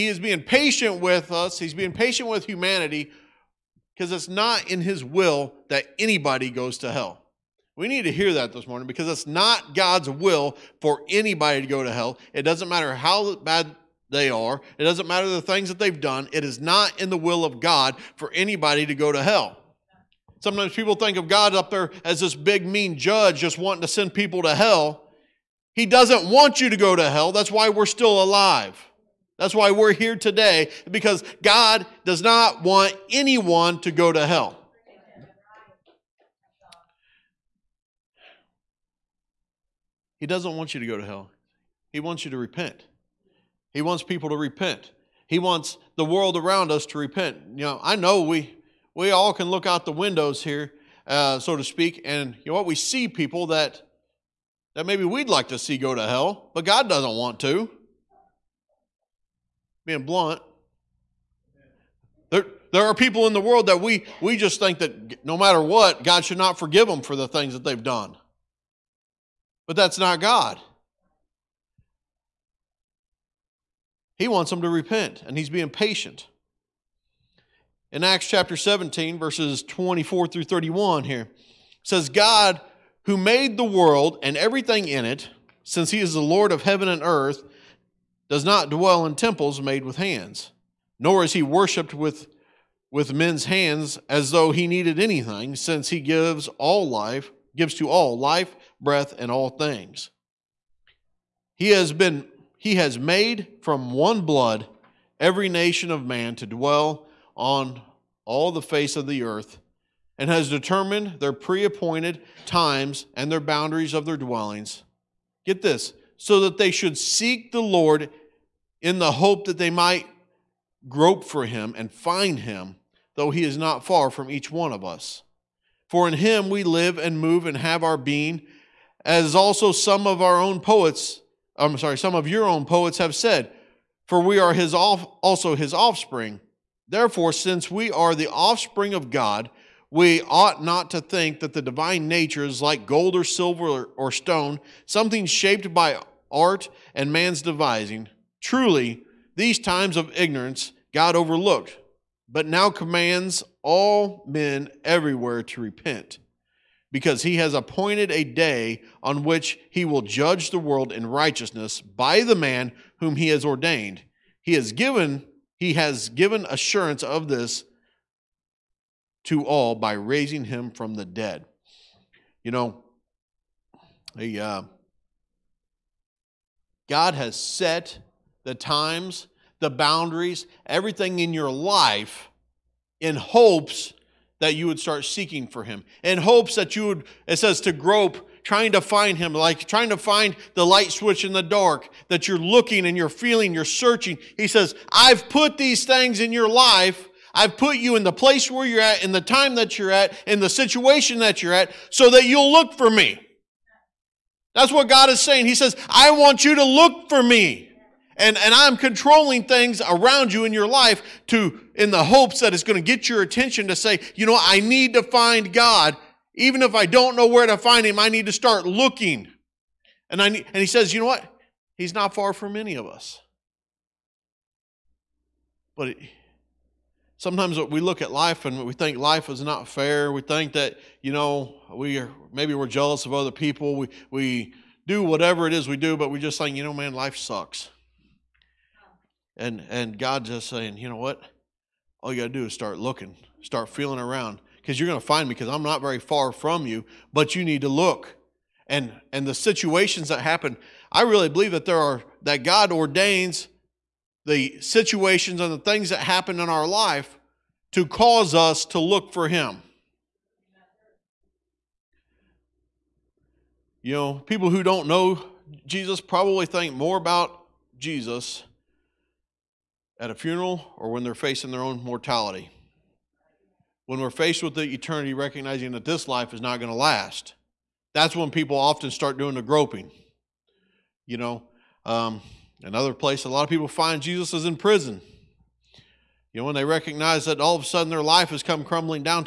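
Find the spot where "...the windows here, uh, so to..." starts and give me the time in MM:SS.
00:49.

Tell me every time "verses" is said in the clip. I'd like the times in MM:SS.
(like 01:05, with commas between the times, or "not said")
01:19.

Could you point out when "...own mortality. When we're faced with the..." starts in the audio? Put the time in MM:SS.
04:31.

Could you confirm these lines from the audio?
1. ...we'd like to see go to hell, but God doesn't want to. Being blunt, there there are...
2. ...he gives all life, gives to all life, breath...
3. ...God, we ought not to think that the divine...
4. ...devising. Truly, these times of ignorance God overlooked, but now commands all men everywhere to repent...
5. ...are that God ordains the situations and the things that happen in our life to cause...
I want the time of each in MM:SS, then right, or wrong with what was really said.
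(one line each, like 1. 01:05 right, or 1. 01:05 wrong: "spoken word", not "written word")
1. 00:55 right
2. 01:35 right
3. 02:19 right
4. 02:27 right
5. 04:11 right.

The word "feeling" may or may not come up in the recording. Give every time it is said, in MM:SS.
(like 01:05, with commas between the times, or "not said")
03:13, 04:03.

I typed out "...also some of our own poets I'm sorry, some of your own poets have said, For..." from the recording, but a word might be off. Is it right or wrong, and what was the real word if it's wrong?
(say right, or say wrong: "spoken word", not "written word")
right.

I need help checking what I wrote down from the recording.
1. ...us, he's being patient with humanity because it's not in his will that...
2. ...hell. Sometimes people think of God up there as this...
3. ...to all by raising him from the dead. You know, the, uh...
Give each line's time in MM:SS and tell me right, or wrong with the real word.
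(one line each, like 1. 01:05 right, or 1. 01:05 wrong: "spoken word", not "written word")
1. 00:01 right
2. 00:19 right
3. 02:49 right.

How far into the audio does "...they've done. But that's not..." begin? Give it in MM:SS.
01:07.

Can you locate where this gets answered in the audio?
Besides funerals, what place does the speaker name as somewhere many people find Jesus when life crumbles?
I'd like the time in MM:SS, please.
04:44.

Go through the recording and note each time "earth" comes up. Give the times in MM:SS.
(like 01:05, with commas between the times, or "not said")
01:27, 01:49.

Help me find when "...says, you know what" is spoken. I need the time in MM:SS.
03:40.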